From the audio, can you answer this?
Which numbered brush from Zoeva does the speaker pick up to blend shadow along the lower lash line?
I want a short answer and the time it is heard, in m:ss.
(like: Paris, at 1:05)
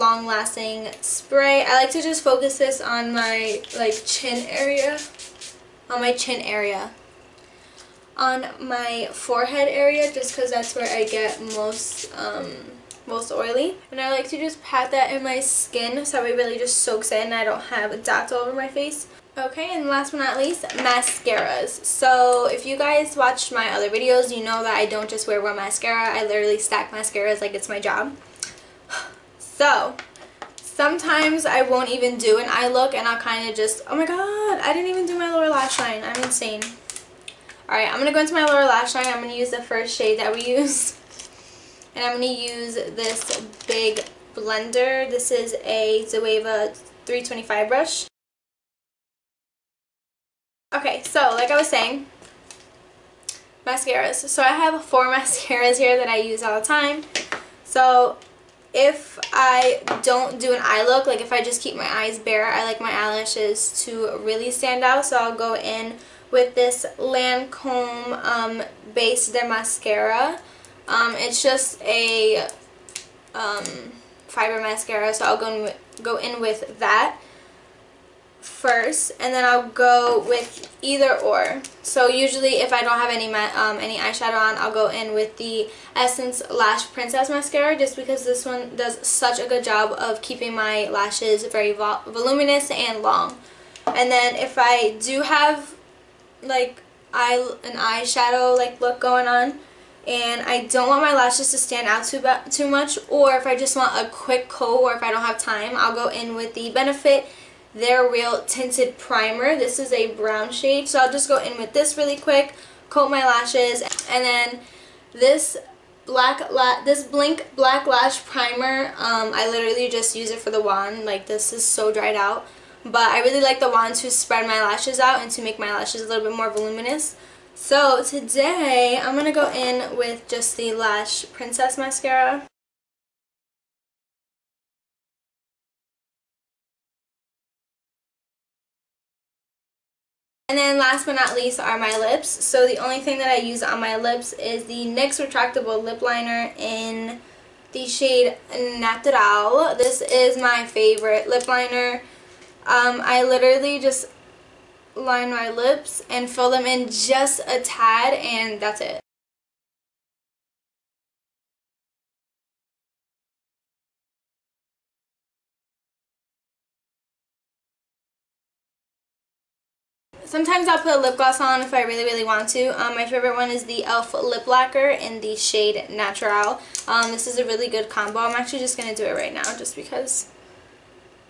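325, at 0:46.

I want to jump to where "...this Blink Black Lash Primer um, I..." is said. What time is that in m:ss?
1:56.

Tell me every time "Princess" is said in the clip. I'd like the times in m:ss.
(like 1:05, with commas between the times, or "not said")
1:26, 2:11.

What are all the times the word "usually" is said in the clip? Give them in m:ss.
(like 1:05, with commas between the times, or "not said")
1:22.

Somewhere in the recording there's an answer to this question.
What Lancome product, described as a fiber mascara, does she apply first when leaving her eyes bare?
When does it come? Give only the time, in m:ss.
1:08.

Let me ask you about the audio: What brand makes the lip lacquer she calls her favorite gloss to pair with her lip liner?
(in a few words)
e.l.f.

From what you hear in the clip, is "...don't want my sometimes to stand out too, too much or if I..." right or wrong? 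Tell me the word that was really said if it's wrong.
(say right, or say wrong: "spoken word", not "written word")
wrong: "lashes", not "sometimes".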